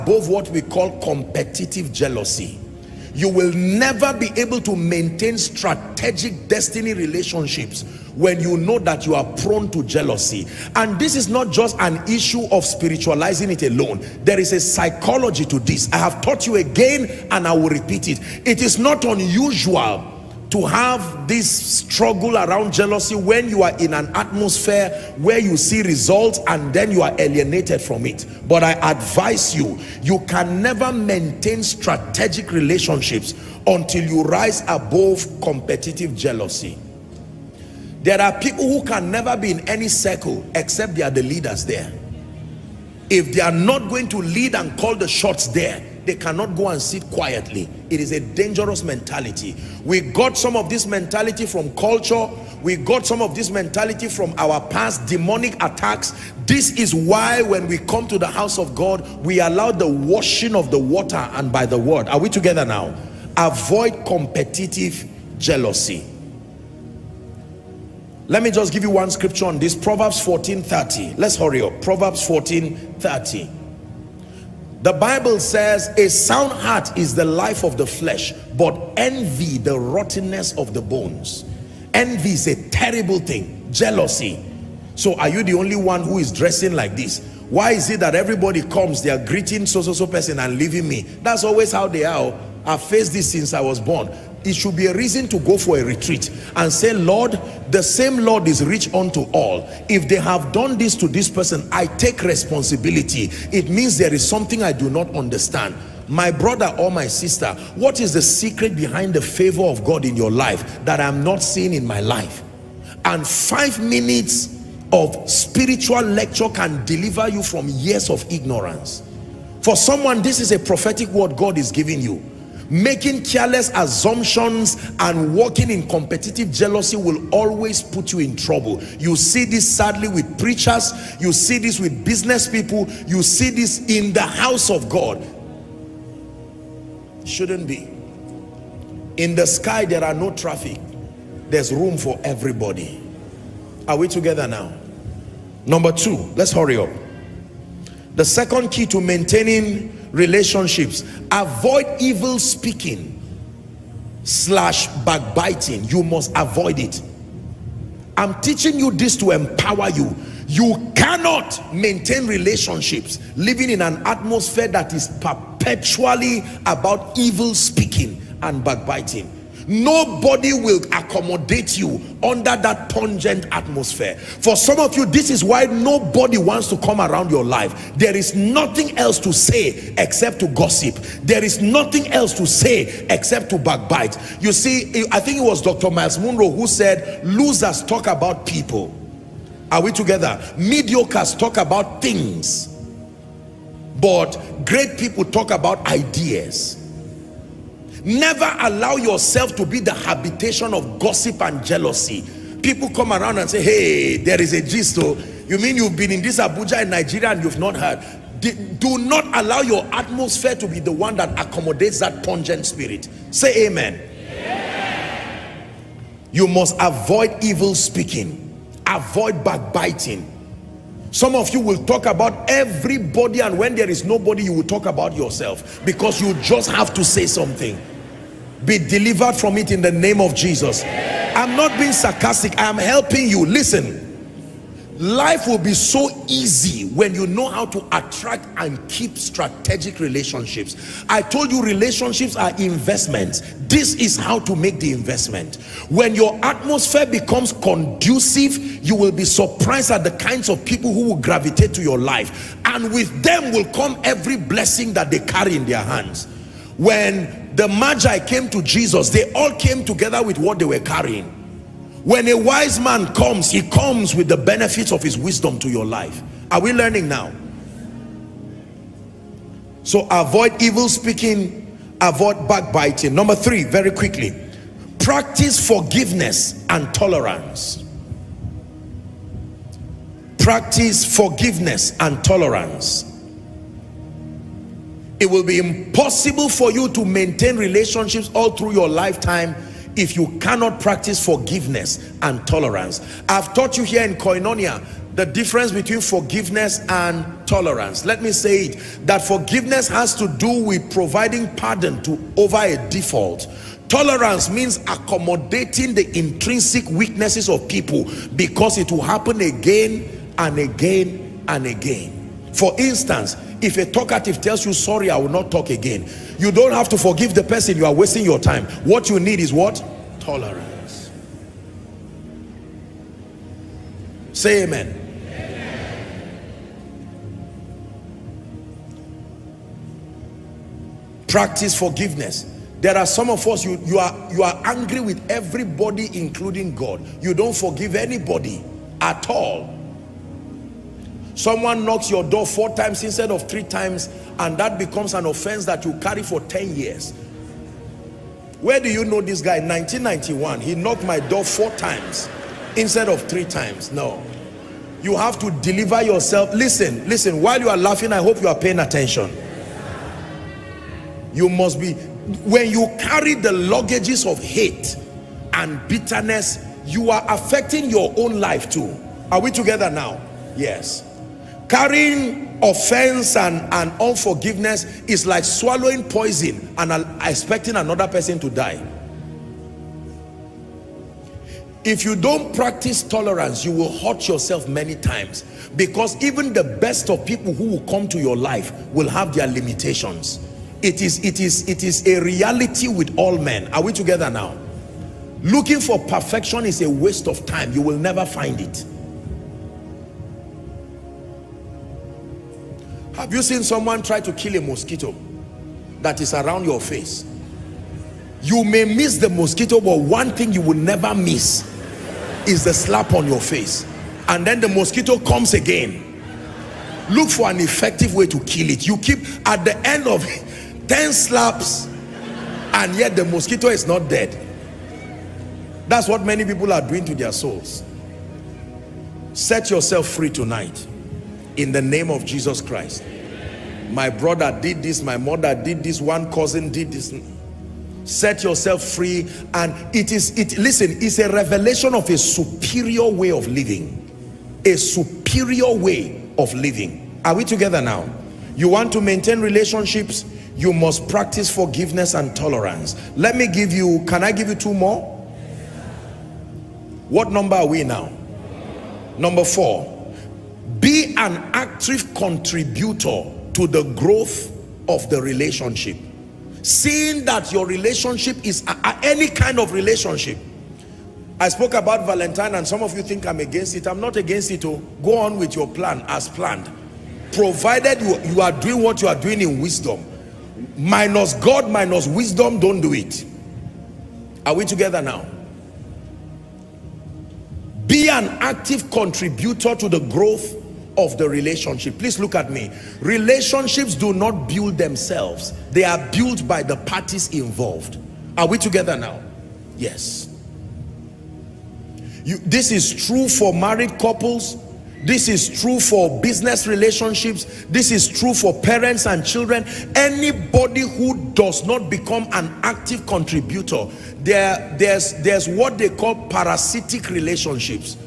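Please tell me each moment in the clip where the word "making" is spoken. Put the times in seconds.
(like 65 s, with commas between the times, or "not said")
122 s.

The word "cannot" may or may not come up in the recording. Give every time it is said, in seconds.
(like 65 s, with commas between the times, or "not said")
46 s, 160 s, 290 s.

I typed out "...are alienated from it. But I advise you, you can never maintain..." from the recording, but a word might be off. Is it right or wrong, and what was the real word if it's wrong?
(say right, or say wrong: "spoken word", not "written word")
right.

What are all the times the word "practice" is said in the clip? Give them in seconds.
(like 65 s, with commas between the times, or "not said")
274 s, 280 s, 290 s, 331 s, 382 s, 451 s.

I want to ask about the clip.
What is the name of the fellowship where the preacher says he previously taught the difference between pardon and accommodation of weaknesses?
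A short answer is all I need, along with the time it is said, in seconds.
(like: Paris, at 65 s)
Koinonia, at 294 s.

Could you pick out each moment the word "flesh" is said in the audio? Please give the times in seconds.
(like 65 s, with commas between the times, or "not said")
77 s.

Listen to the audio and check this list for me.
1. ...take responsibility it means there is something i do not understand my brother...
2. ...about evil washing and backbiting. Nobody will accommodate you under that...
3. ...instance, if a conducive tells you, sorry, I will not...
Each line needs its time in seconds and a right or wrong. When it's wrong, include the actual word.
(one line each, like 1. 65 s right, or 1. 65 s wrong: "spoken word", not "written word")
1. 101 s right
2. 166 s wrong: "speaking", not "washing"
3. 312 s wrong: "talkative", not "conducive".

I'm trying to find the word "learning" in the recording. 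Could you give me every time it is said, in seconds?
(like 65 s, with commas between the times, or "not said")
266 s.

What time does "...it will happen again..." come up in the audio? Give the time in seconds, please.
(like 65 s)
308 s.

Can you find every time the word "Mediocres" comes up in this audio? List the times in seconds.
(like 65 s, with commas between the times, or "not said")
190 s.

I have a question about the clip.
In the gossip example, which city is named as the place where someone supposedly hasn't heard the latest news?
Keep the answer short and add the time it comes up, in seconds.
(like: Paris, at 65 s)
Abuja, at 206 s.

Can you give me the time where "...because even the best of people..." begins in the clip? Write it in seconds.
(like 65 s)
385 s.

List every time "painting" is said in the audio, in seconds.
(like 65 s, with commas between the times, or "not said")
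not said.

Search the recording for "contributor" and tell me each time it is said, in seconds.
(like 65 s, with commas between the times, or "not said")
462 s, 488 s, 513 s.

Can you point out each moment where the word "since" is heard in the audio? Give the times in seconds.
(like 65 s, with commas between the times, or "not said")
93 s.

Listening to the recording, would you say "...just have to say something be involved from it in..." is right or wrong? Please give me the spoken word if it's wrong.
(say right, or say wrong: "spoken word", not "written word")
wrong: "delivered", not "involved".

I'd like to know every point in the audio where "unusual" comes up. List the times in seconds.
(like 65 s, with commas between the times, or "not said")
19 s.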